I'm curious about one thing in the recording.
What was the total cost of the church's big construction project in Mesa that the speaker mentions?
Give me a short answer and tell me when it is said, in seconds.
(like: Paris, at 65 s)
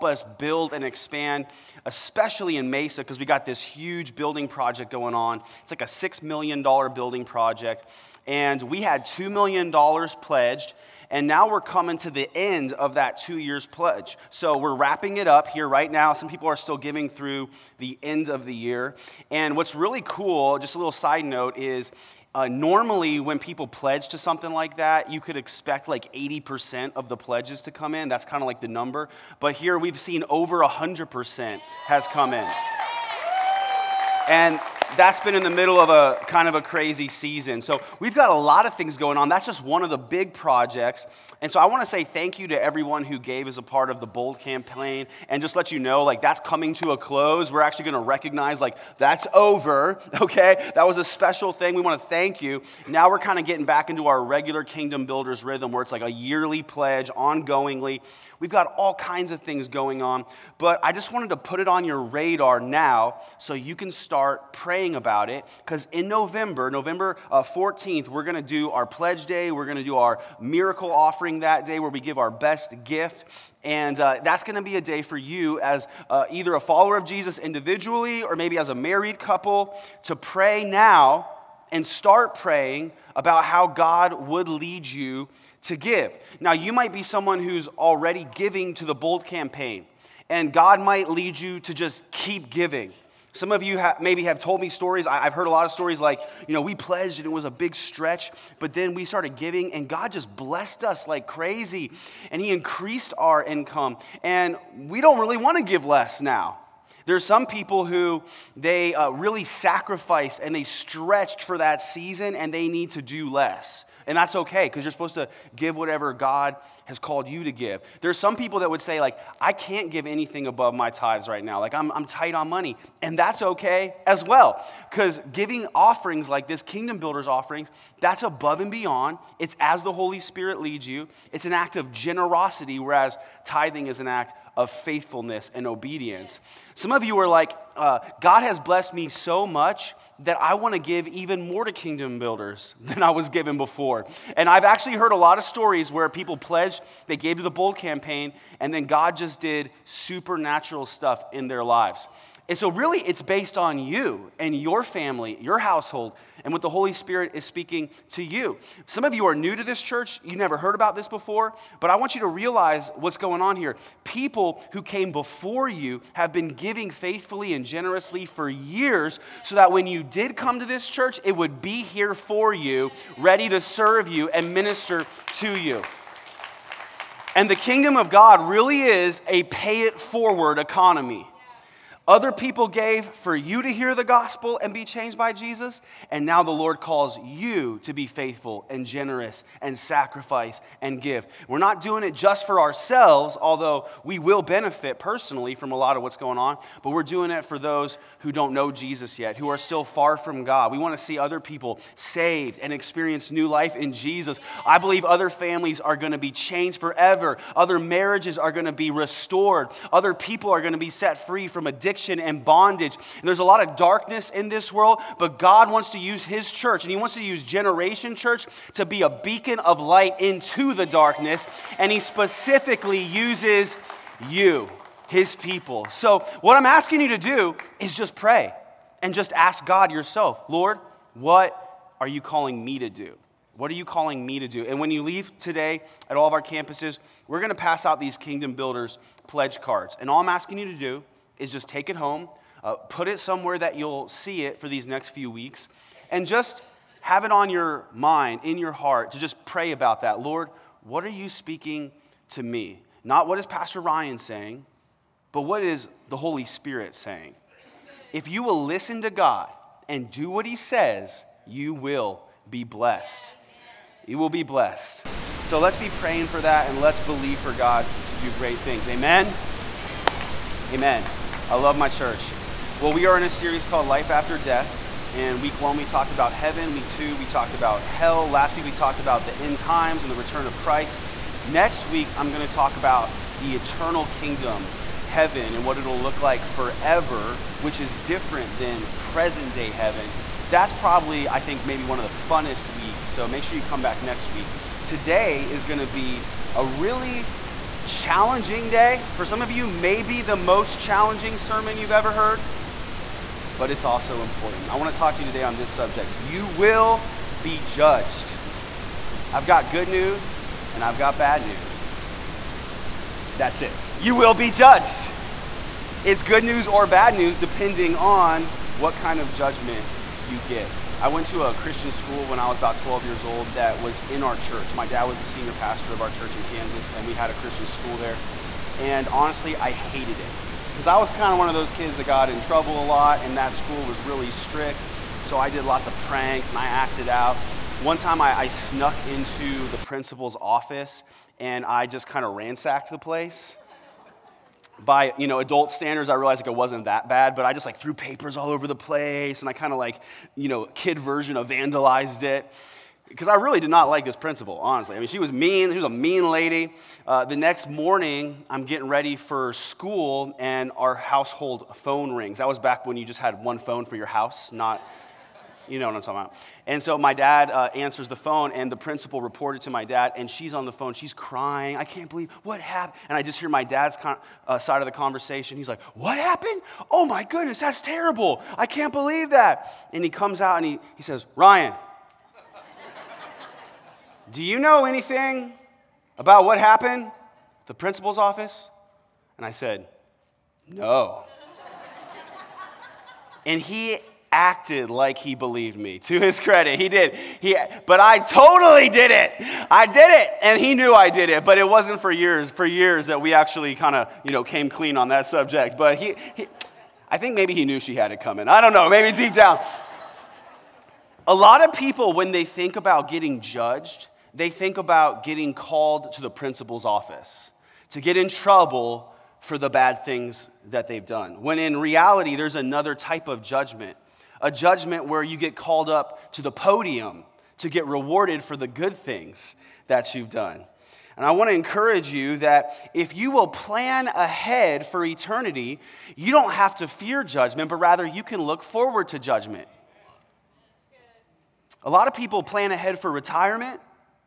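$6 million, at 5 s.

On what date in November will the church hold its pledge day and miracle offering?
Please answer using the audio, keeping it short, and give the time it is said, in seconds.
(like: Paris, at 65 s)
November 14th, at 66 s.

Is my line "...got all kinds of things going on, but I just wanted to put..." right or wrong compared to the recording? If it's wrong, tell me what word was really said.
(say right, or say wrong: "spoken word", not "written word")
right.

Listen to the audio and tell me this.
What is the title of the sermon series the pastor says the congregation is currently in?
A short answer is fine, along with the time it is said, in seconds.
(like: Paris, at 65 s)
Life After Death, at 273 s.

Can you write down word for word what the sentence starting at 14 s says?
So we're wrapping it up here right now.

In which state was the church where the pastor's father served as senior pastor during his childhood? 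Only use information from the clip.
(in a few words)
Kansas.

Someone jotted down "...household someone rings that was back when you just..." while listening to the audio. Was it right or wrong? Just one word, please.
wrong.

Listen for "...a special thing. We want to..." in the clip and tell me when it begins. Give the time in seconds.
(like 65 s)
50 s.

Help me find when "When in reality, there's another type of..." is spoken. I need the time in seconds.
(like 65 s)
421 s.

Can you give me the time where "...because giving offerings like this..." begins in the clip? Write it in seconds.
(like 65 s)
124 s.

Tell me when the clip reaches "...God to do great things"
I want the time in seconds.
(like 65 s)
267 s.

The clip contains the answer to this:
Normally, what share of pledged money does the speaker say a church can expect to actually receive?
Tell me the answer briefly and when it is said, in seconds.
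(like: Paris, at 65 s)
80%, at 26 s.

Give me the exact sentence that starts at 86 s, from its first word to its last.
Now, you might be someone who's already giving to the Bold campaign, and God might lead you to just keep giving.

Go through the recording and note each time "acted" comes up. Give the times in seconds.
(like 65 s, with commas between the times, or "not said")
336 s, 394 s.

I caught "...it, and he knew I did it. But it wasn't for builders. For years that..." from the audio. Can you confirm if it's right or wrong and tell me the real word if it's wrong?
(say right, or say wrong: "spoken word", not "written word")
wrong: "years", not "builders".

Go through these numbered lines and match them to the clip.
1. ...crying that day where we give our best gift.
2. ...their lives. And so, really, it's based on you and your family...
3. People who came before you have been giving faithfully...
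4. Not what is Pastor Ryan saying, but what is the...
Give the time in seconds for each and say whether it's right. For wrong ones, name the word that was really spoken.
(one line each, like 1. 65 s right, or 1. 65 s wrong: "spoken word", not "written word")
1. 70 s wrong: "offering", not "crying"
2. 151 s right
3. 164 s right
4. 253 s right.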